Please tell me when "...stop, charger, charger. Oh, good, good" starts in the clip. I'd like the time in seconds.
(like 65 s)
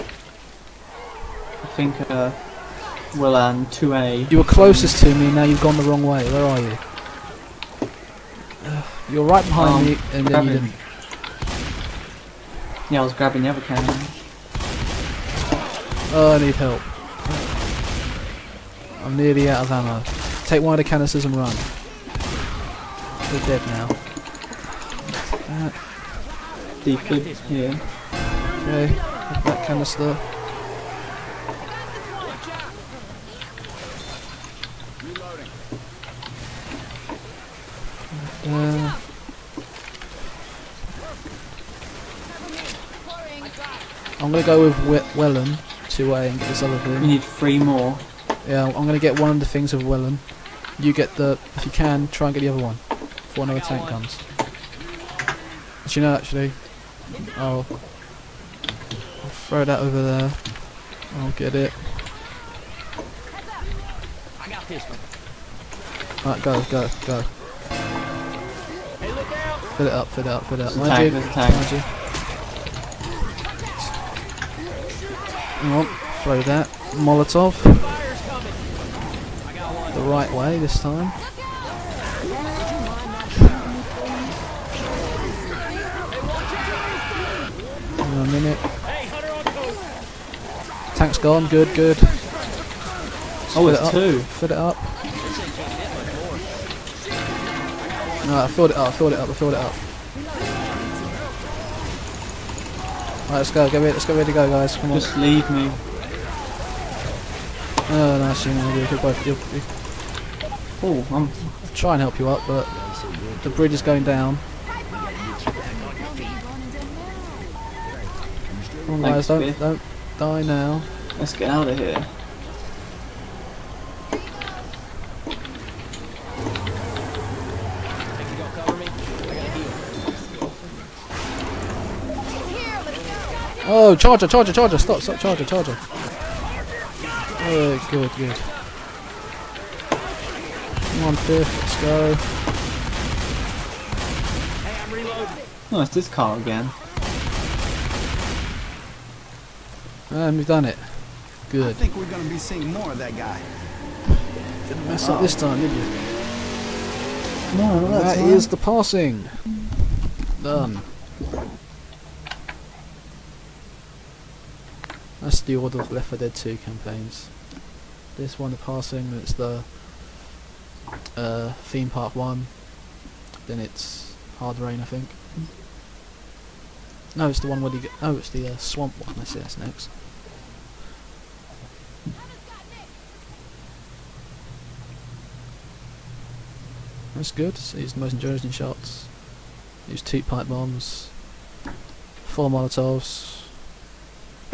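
134 s.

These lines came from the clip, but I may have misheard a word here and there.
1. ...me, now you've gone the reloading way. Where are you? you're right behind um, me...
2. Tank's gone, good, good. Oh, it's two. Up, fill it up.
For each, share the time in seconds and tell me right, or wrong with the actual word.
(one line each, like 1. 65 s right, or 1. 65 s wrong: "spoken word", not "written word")
1. 5 s wrong: "wrong", not "reloading"
2. 90 s right.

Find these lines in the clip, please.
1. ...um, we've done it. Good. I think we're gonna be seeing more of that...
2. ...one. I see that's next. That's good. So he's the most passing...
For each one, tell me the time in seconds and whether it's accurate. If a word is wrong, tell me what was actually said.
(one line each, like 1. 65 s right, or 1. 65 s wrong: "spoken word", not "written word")
1. 150 s right
2. 179 s wrong: "interesting", not "passing".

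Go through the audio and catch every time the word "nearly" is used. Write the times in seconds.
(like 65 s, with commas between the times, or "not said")
19 s.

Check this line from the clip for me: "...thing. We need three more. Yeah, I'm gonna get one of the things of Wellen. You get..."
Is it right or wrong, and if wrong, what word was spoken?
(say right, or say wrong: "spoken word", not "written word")
right.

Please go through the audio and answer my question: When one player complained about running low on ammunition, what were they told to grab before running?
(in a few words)
One of the canisters.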